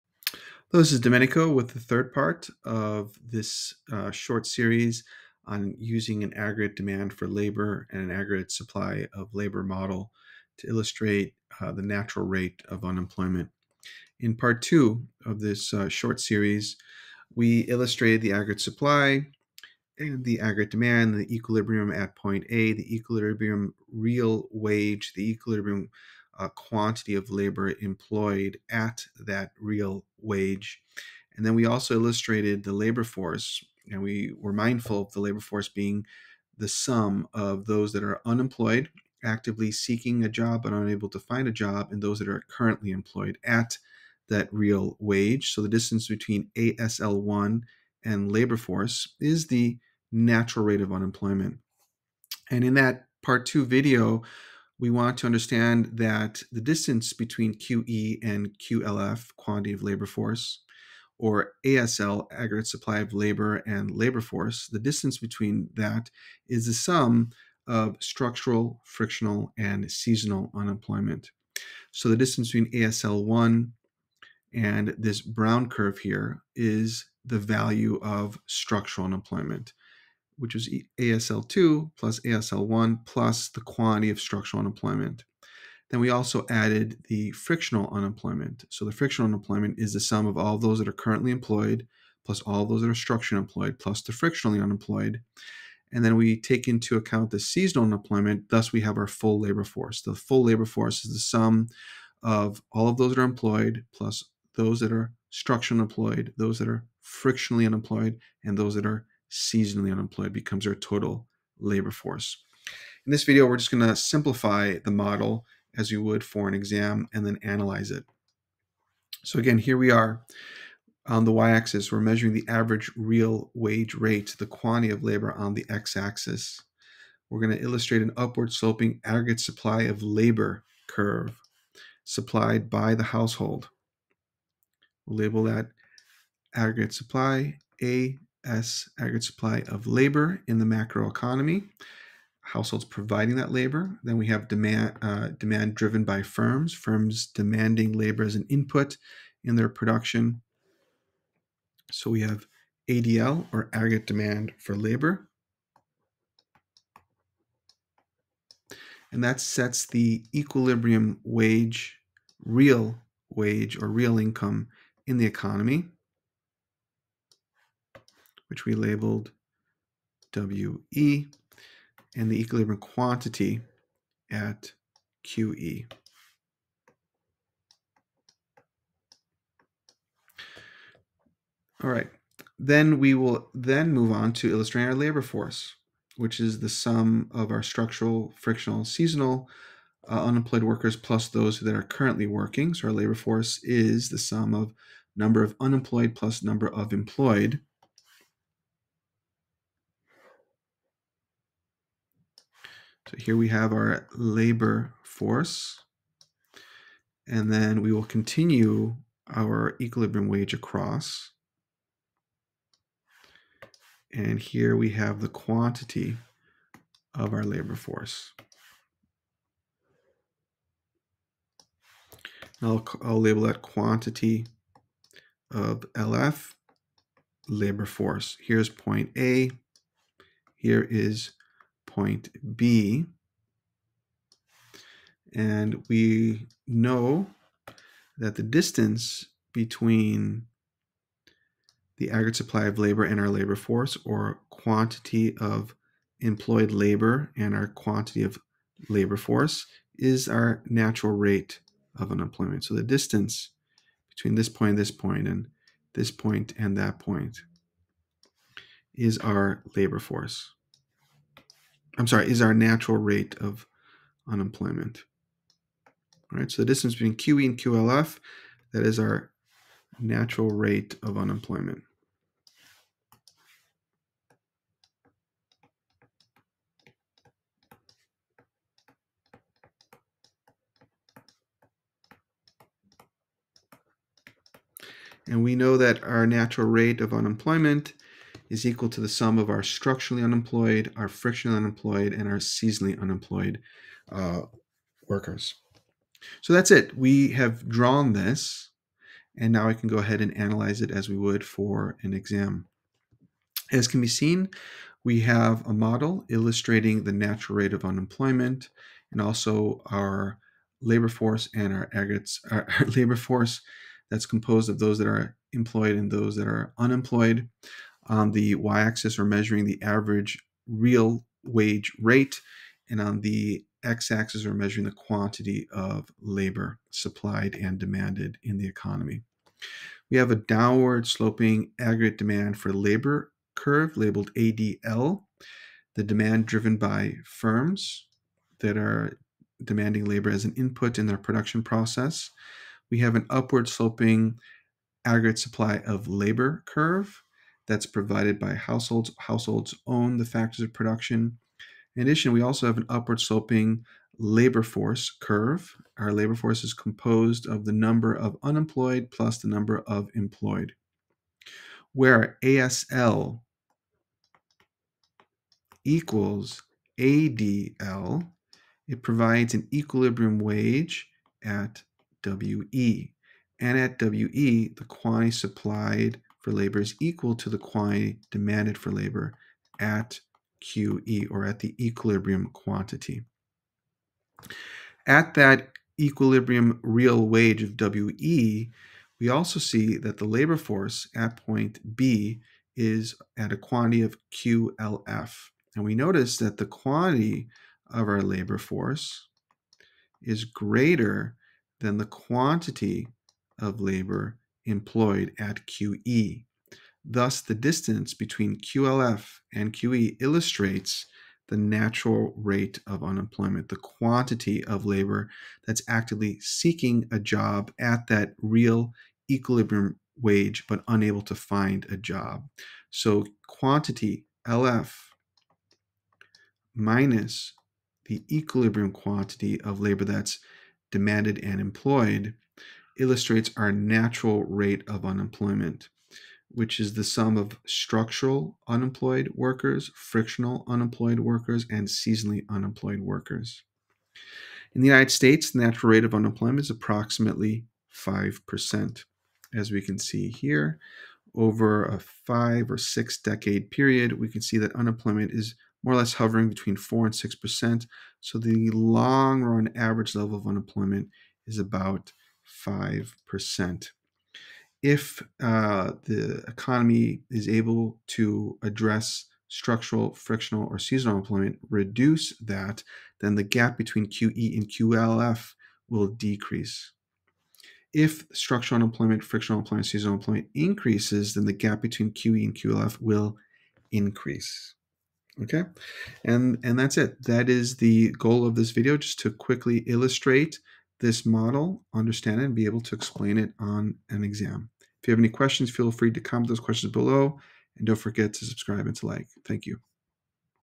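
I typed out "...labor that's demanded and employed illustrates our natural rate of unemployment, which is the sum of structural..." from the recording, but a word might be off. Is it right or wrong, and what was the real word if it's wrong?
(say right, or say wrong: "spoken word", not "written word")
right.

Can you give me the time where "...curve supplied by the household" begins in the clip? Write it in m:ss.
2:10.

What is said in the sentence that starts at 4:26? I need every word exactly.
All right, so the distance between QE and QLF, that is our natural rate of unemployment.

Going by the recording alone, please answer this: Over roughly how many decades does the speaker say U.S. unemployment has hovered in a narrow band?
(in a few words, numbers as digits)
5 or 6.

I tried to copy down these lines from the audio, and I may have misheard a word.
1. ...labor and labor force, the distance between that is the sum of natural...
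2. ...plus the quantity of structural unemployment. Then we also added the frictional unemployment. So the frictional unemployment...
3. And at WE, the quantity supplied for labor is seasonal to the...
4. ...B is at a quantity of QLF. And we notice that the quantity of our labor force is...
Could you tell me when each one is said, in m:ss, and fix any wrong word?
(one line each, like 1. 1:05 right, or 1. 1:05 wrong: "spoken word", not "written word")
1. 1:03 wrong: "structural", not "natural"
2. 1:23 right
3. 6:13 wrong: "equal", not "seasonal"
4. 6:31 right.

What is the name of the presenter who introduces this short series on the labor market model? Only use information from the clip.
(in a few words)
Domenico.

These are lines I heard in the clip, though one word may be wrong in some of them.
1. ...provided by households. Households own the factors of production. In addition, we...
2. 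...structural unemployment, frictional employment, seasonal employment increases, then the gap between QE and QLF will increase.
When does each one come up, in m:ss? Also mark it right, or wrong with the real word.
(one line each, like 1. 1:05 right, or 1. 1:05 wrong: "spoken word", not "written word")
1. 5:47 right
2. 7:58 right.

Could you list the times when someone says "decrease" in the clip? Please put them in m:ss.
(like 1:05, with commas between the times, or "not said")
7:56.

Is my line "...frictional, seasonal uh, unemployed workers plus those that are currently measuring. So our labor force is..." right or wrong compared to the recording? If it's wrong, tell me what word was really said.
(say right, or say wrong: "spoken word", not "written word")
wrong: "working", not "measuring".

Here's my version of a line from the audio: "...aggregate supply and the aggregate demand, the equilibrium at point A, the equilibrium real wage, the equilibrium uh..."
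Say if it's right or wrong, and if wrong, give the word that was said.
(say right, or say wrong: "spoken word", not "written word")
right.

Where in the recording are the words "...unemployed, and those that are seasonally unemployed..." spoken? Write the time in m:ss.
1:47.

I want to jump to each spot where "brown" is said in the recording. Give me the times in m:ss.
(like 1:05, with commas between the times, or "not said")
1:15.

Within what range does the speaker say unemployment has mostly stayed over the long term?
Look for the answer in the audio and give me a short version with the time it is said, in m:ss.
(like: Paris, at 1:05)
4 to 6%, at 7:36.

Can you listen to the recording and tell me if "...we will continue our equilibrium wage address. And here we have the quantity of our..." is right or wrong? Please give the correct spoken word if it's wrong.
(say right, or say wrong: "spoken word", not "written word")
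wrong: "across", not "address".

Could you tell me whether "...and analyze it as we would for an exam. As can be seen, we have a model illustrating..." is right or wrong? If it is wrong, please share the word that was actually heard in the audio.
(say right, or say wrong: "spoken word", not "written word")
right.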